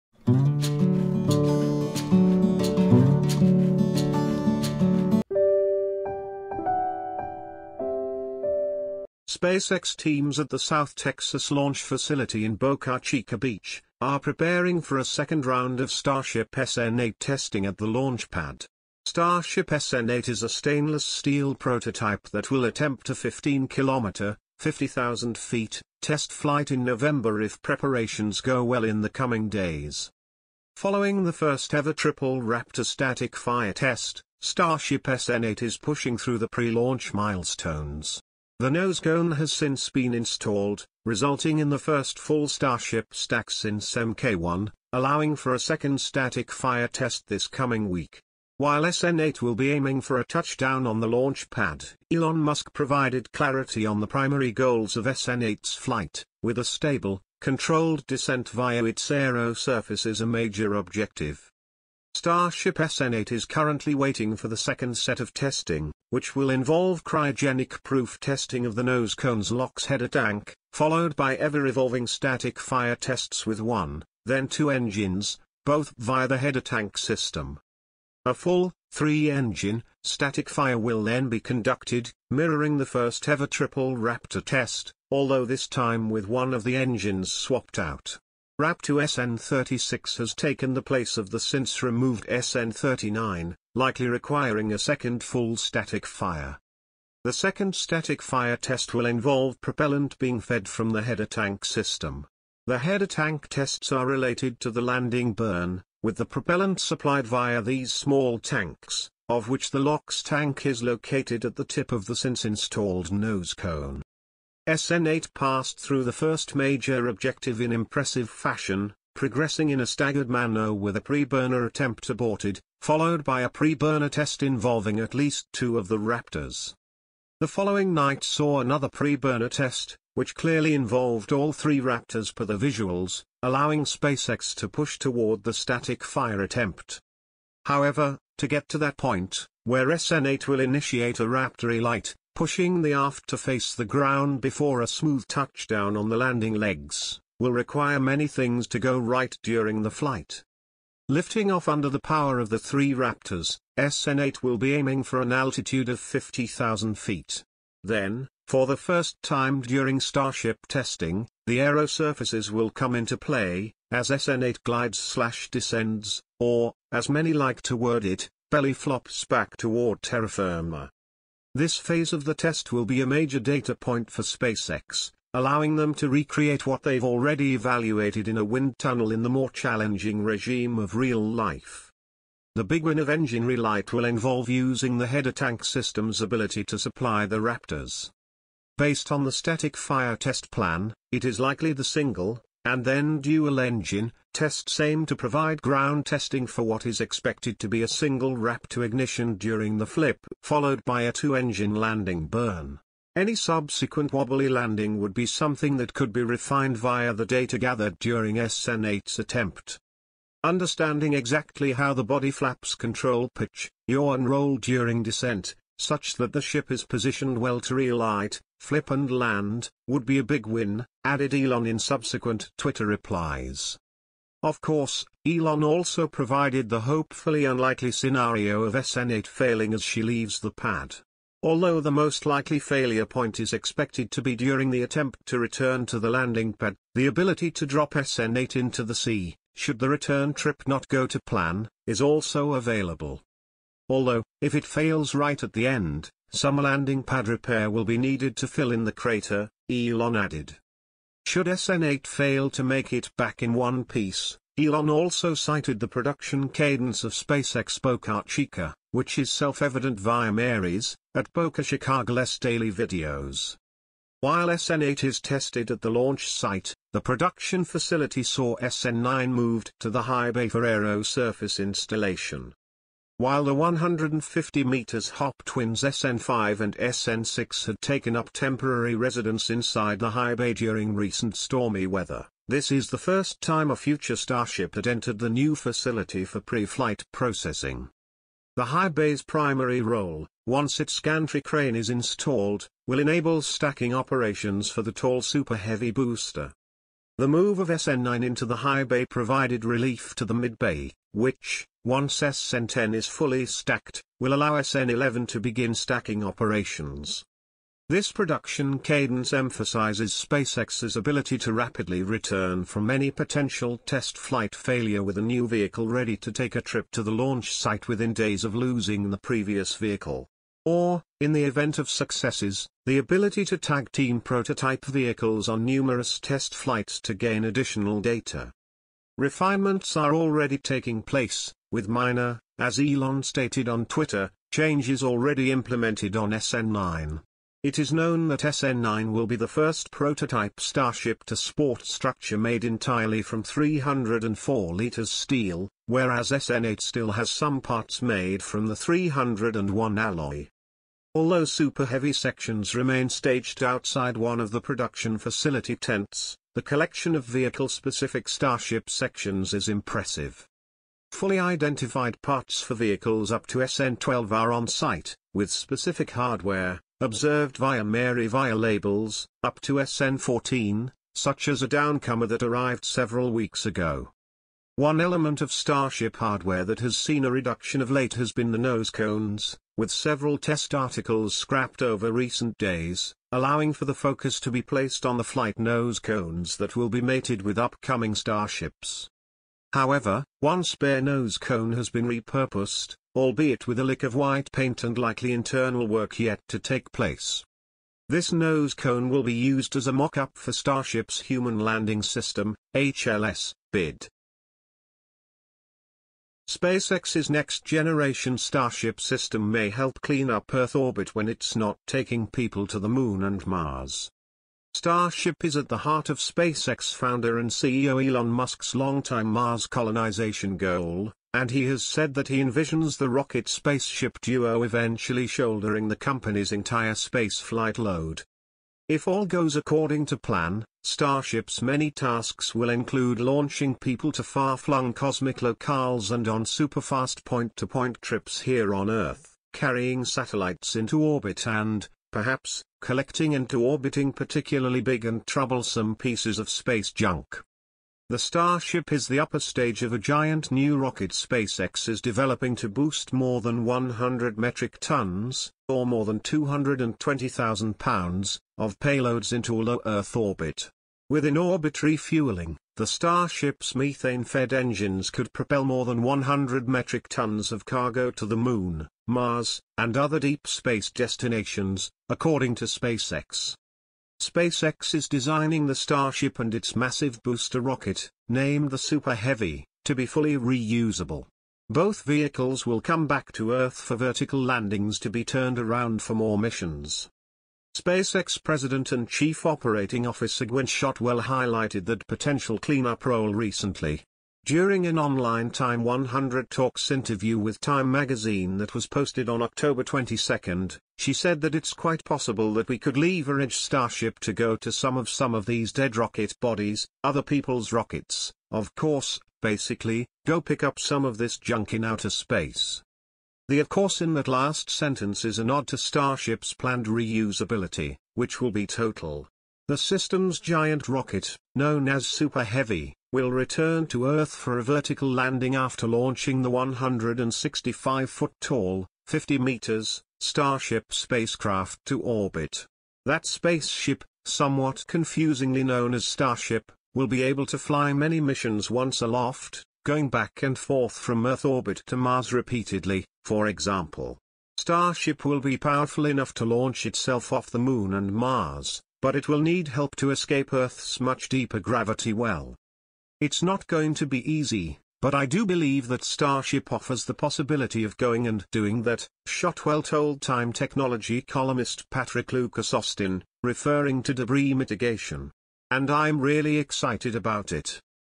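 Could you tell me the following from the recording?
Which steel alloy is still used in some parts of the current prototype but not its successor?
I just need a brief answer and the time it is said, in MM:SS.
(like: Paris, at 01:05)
301, at 05:48.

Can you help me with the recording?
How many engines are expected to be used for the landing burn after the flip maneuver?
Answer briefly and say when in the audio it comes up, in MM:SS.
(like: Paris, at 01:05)
2, at 03:21.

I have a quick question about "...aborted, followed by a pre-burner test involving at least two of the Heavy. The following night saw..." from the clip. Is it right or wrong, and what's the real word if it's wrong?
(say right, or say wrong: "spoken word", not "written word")
wrong: "Raptors", not "Heavy".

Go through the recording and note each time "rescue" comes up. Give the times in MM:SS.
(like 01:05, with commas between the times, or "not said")
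not said.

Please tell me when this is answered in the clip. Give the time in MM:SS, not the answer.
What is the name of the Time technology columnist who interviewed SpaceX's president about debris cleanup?
09:21.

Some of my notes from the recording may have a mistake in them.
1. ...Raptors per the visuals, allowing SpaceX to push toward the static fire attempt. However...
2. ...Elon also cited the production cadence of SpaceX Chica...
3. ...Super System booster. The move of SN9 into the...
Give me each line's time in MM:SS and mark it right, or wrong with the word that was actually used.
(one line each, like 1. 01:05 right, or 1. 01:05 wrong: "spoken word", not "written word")
1. 02:11 right
2. 04:14 wrong: "Boca", not "Chica"
3. 04:55 wrong: "Heavy", not "System".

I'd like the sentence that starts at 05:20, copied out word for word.
Or, in the event of successes, the ability to tag team prototype vehicles on numerous test flights to gain additional data.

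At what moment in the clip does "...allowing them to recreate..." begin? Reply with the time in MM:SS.
02:55.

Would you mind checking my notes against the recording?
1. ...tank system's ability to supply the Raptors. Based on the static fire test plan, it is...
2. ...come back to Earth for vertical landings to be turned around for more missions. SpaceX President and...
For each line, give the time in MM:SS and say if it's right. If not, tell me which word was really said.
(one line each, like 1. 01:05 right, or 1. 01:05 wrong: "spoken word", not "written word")
1. 03:05 right
2. 08:02 right.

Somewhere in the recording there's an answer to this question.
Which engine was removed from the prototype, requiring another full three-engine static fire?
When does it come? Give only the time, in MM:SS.
01:32.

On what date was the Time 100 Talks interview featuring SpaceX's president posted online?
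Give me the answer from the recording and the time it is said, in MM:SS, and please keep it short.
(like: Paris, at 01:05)
October 22, at 08:19.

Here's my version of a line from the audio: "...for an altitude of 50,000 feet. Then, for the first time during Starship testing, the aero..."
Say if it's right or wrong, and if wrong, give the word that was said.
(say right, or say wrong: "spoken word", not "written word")
right.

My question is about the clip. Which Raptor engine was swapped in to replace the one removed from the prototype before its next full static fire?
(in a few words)
Raptor SN36.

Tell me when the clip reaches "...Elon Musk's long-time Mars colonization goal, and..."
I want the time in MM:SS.
06:58.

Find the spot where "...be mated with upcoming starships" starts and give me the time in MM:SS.
06:26.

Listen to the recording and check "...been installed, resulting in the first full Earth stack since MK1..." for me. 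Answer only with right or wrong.
wrong.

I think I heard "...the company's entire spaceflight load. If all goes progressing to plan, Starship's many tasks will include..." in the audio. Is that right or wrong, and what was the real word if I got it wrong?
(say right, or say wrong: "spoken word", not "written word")
wrong: "according", not "progressing".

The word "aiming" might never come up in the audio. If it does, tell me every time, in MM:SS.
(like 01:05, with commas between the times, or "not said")
00:49, 02:34.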